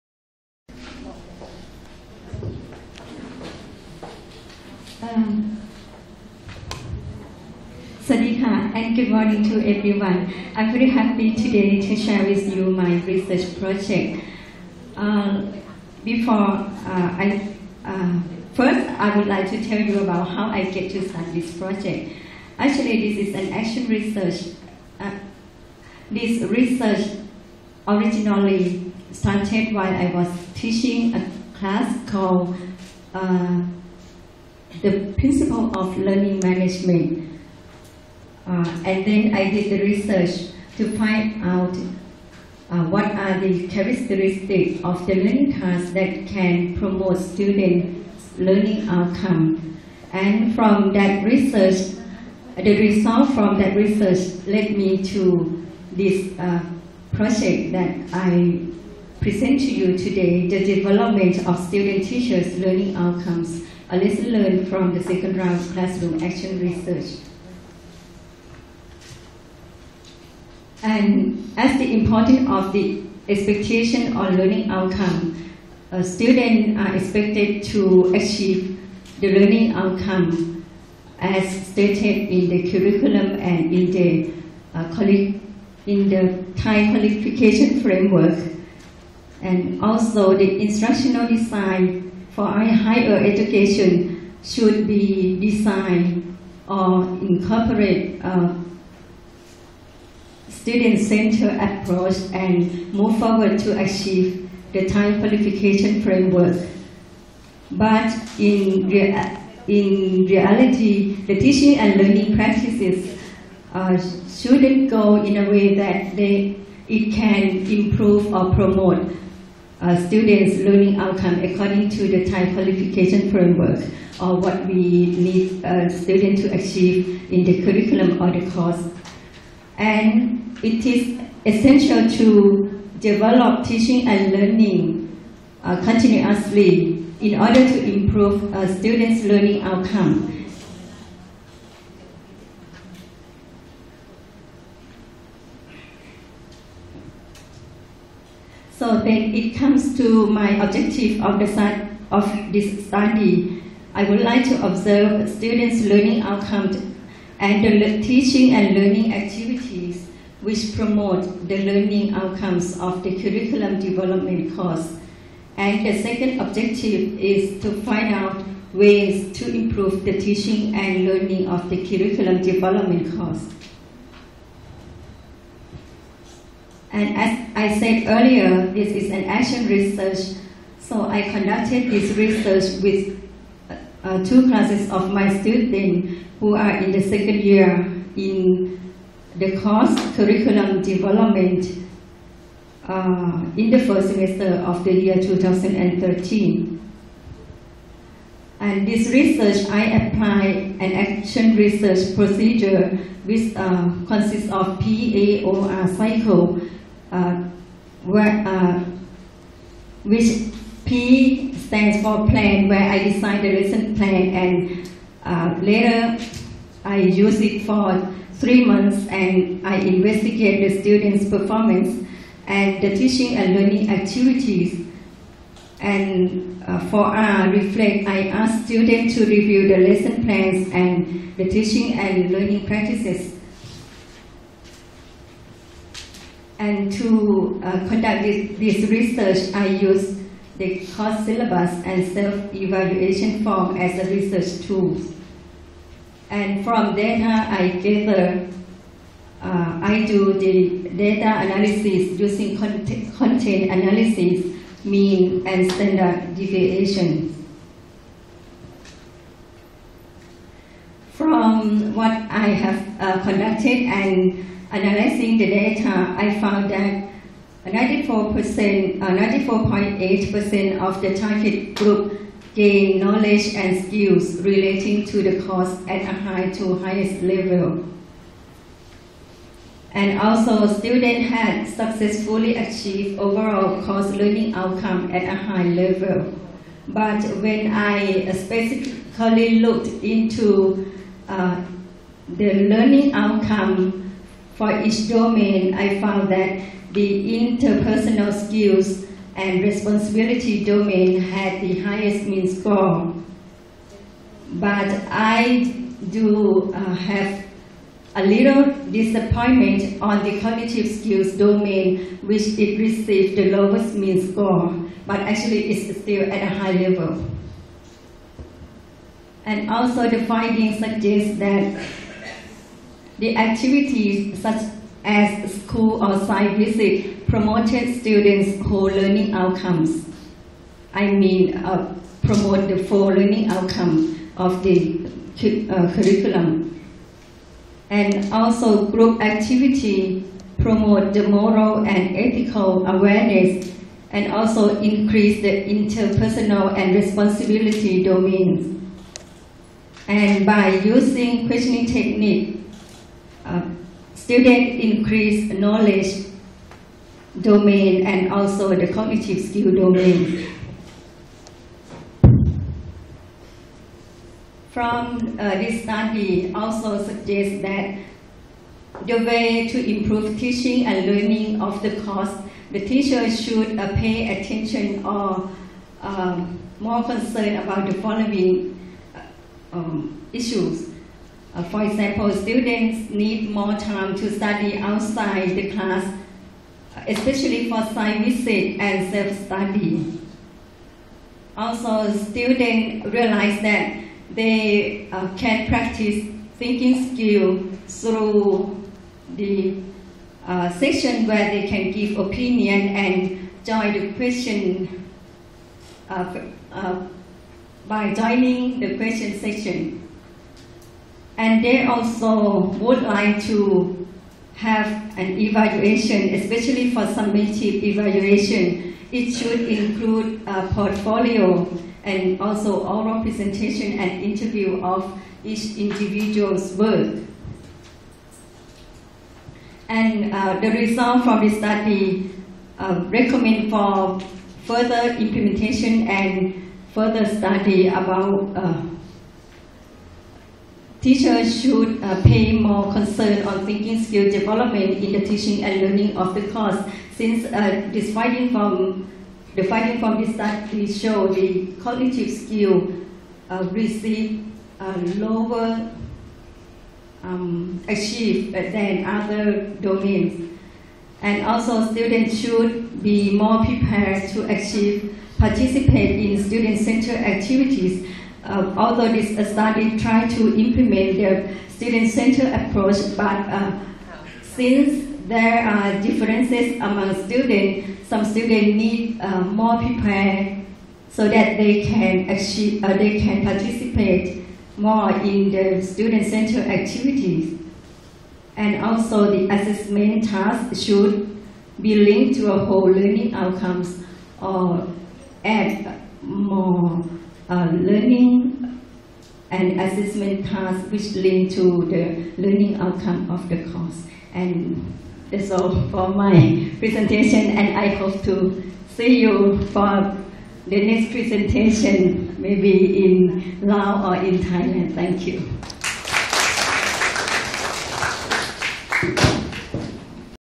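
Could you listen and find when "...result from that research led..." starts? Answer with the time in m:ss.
0:52.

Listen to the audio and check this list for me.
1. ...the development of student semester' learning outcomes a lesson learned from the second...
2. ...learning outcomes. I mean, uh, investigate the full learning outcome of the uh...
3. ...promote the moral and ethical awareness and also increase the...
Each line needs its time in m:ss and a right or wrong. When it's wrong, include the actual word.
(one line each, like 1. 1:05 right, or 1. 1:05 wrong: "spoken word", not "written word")
1. 1:00 wrong: "teachers", not "semester"
2. 5:28 wrong: "promote", not "investigate"
3. 5:40 right.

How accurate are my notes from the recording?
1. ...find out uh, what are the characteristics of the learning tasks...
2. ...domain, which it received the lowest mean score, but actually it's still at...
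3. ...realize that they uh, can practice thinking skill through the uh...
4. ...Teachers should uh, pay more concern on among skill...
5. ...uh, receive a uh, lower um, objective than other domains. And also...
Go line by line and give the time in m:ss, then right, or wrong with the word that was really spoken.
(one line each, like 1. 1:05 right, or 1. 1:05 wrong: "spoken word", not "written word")
1. 0:40 right
2. 5:11 right
3. 6:33 right
4. 7:21 wrong: "thinking", not "among"
5. 7:33 wrong: "achieve", not "objective".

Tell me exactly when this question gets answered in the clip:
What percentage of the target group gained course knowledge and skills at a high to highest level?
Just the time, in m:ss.
4:28.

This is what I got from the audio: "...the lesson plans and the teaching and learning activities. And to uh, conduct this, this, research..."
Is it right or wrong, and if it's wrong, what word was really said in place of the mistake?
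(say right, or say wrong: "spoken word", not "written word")
wrong: "practices", not "activities".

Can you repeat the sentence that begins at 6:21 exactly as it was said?
Uh, for example, students need more time to study outside the class, especially for site visit and self-study.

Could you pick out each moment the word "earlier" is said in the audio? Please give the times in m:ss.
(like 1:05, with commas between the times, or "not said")
2:58.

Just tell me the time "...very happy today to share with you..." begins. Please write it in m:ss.
0:10.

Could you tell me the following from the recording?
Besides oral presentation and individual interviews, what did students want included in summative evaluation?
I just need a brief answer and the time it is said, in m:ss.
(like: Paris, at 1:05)
Portfolio, at 7:00.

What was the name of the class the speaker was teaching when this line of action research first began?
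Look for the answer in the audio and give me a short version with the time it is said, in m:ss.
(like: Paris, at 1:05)
Principle of learning management, at 0:35.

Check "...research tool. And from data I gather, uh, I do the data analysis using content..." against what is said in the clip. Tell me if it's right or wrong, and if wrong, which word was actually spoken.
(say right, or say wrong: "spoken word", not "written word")
right.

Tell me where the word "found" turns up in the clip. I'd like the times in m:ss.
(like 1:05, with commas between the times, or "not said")
4:26, 4:55.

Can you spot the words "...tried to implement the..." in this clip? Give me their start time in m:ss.
7:49.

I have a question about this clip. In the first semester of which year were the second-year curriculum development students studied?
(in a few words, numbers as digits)
2013.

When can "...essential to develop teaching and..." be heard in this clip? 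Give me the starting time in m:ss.
2:11.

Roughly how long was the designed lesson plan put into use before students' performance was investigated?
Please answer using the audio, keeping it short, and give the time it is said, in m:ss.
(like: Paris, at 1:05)
Three months, at 3:38.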